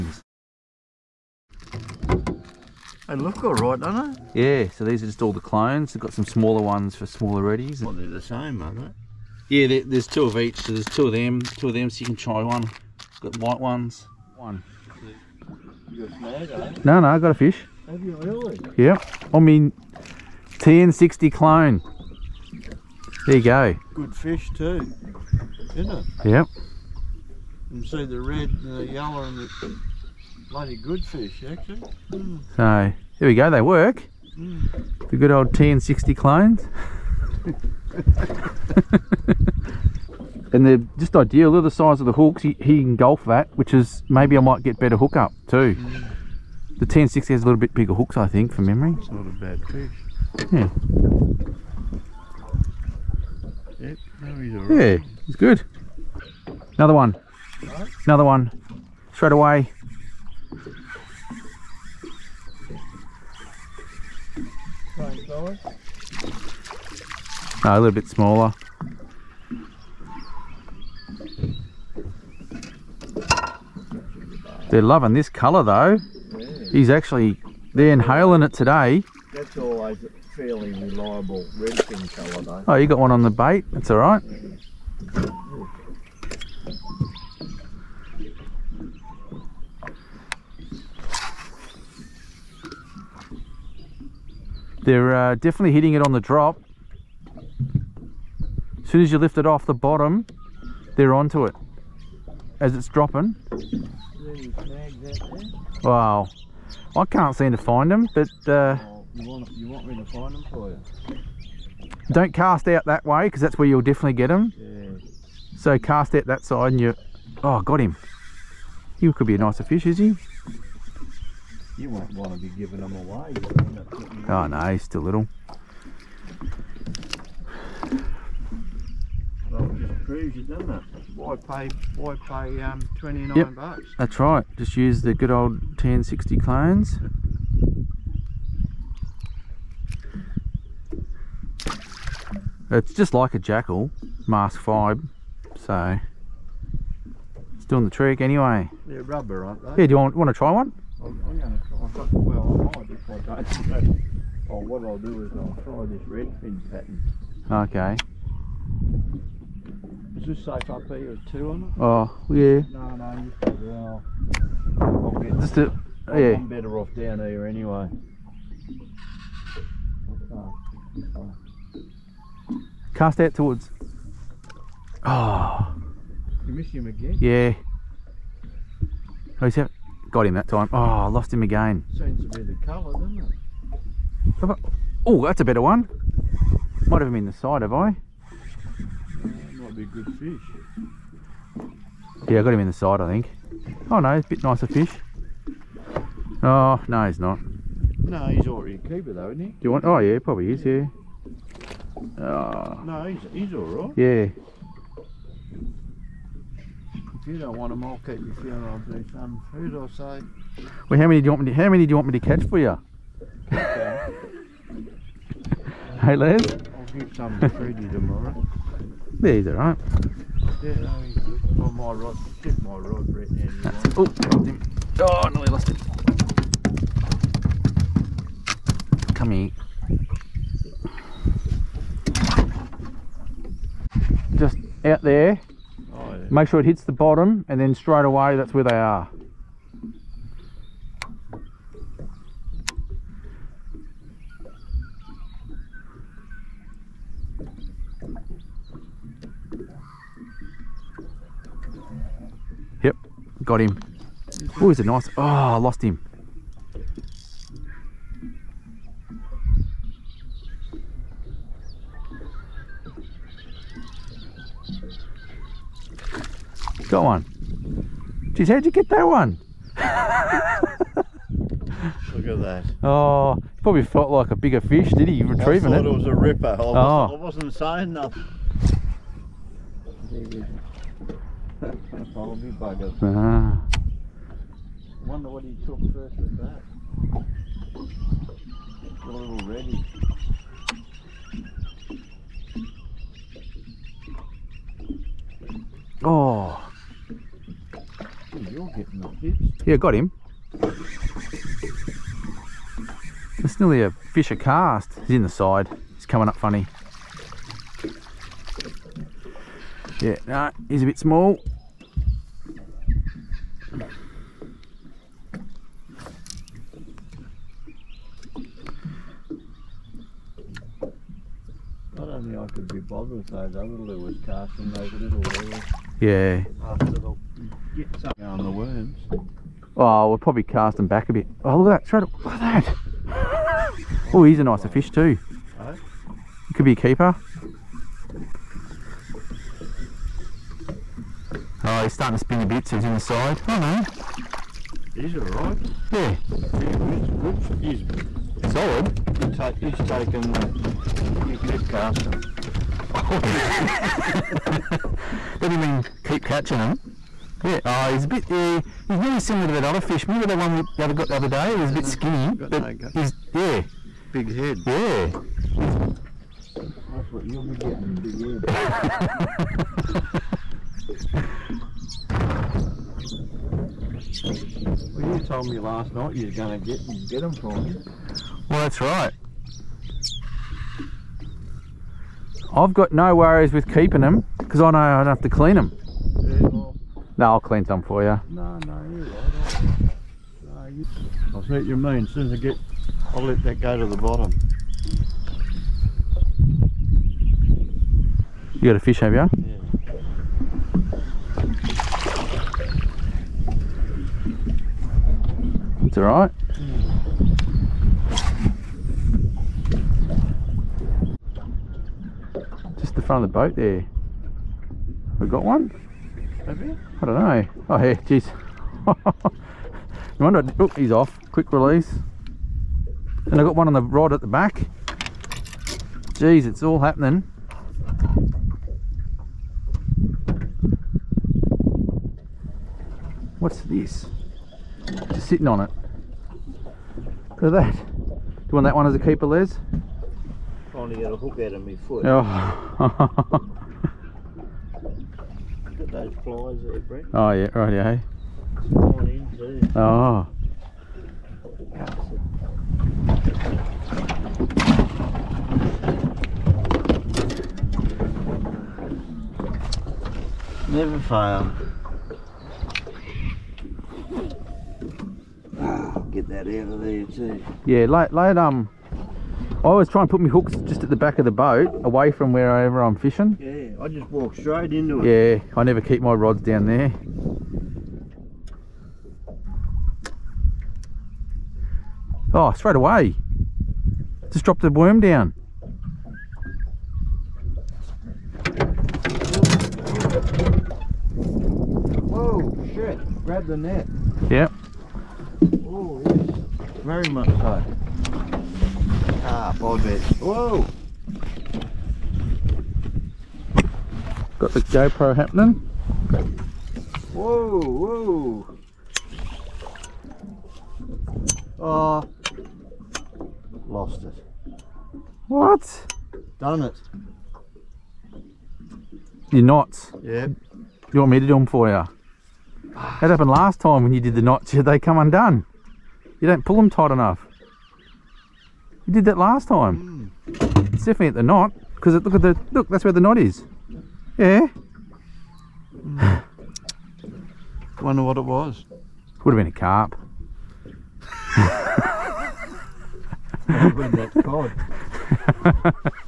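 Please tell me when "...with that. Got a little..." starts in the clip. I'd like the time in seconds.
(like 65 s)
286 s.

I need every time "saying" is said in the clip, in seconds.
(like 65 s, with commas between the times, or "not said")
277 s.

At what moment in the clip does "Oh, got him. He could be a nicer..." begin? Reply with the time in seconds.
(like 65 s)
117 s.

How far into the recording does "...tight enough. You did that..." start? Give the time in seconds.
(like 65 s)
526 s.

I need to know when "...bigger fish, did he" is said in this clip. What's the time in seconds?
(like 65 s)
274 s.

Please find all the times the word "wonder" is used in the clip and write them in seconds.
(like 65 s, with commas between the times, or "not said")
285 s, 420 s, 537 s.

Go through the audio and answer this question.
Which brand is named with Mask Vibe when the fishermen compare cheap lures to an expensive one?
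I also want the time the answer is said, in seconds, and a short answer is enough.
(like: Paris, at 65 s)
Jackall, at 143 s.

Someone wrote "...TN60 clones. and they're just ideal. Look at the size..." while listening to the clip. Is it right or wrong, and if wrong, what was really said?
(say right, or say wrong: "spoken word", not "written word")
right.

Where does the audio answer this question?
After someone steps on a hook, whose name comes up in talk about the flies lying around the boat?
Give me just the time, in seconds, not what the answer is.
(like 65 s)
446 s.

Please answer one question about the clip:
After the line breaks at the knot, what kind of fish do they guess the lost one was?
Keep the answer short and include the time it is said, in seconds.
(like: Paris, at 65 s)
Carp, at 539 s.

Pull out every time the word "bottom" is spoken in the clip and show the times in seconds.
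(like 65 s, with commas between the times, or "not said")
99 s, 236 s, 393 s.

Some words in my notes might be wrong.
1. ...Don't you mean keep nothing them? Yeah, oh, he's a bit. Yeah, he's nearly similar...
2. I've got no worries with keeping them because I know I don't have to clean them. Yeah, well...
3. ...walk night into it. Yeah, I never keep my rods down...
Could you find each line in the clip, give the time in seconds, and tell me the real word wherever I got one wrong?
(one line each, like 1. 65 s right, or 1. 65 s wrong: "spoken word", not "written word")
1. 355 s wrong: "catching", not "nothing"
2. 382 s right
3. 474 s wrong: "straight", not "night".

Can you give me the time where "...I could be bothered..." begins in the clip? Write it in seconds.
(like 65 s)
322 s.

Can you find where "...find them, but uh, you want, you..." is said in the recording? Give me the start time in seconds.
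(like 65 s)
107 s.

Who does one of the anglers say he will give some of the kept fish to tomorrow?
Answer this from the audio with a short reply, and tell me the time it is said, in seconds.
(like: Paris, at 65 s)
Freddie, at 217 s.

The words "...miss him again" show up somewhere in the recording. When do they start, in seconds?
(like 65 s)
176 s.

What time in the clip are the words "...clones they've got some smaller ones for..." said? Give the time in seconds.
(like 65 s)
5 s.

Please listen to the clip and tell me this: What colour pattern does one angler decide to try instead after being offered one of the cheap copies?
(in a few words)
Red fin.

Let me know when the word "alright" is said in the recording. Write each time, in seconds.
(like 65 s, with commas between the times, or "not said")
345 s, 405 s.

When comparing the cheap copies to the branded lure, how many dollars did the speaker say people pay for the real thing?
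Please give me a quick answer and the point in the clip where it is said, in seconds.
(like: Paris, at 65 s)
29, at 132 s.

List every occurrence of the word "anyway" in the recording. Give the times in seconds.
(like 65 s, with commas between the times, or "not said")
148 s, 167 s.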